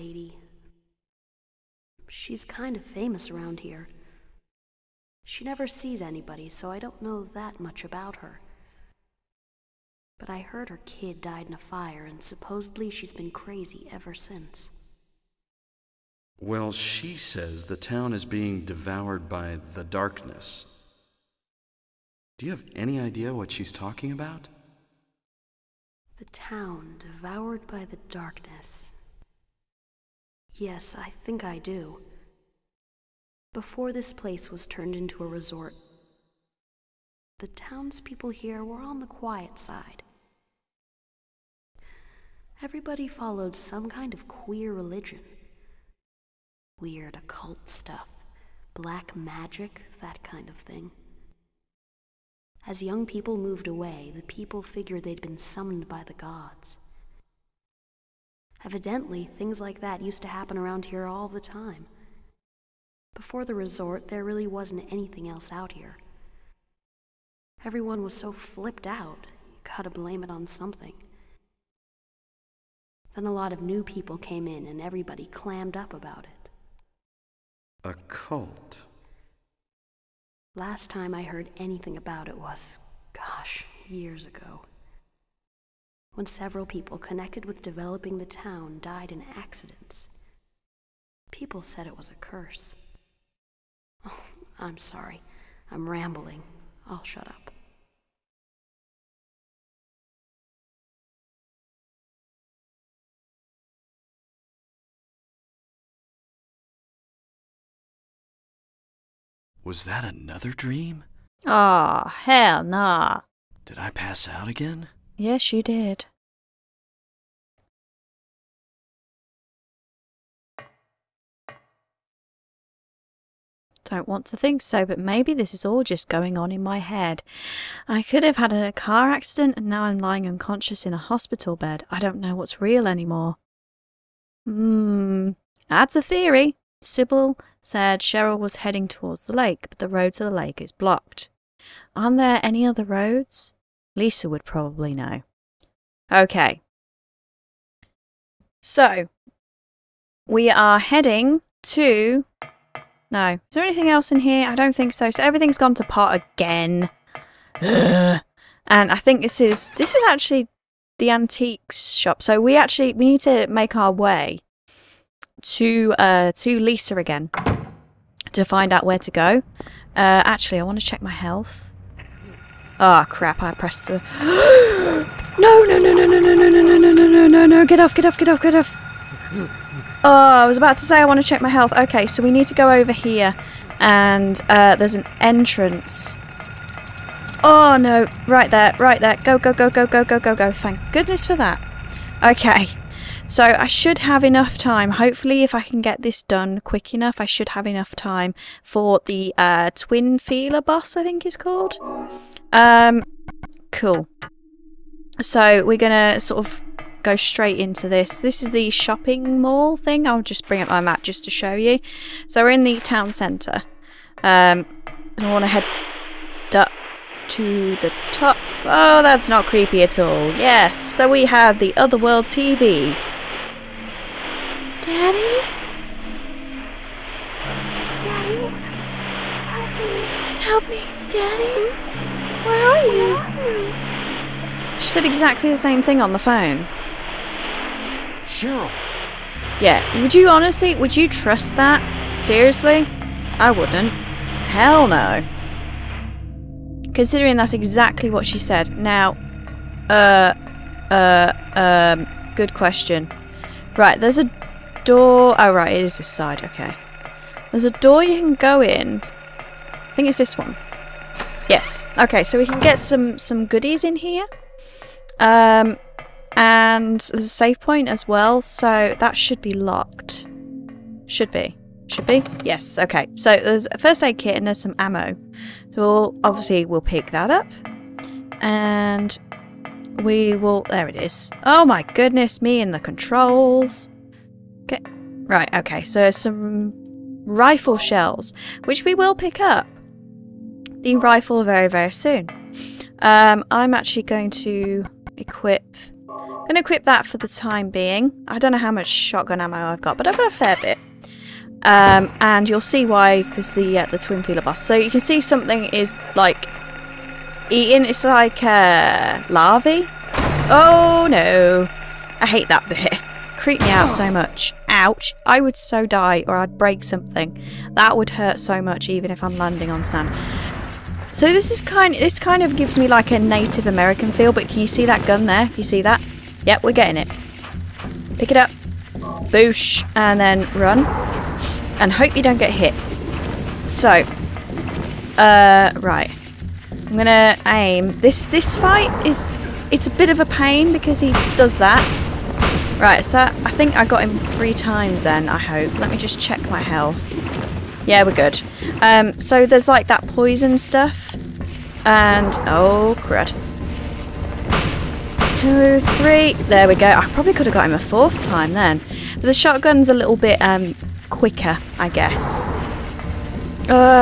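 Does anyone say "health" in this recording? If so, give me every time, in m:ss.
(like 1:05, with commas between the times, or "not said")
2:51, 3:01, 5:46.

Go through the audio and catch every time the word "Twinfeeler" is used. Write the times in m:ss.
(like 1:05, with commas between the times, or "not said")
3:19, 5:03.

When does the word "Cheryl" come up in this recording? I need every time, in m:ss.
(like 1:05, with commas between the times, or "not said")
2:17, 3:58.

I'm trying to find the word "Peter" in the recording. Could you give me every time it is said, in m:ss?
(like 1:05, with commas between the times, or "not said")
not said.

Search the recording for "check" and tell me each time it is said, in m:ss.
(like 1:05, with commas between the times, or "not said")
2:50, 3:01, 5:46.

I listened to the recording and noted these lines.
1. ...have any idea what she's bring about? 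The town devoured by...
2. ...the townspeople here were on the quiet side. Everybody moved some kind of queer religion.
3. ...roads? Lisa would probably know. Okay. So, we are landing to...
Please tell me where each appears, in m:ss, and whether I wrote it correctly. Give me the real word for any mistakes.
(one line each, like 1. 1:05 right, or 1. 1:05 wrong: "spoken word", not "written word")
1. 0:22 wrong: "talking", not "bring"
2. 0:37 wrong: "followed", not "moved"
3. 2:22 wrong: "heading", not "landing".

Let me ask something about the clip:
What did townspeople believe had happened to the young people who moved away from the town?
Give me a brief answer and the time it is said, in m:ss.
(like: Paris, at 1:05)
Summoned by the gods, at 0:55.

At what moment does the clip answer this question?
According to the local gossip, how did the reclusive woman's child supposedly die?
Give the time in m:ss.
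0:11.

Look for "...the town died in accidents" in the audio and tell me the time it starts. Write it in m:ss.
1:28.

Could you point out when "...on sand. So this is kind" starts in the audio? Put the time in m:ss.
5:19.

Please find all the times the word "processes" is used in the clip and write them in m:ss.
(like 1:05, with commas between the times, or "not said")
not said.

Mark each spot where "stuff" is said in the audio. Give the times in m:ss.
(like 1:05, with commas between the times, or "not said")
0:47, 5:50.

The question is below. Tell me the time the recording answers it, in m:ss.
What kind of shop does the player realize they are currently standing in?
2:41.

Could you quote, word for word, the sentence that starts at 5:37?
This this fight is it's a bit of a pain because he does that.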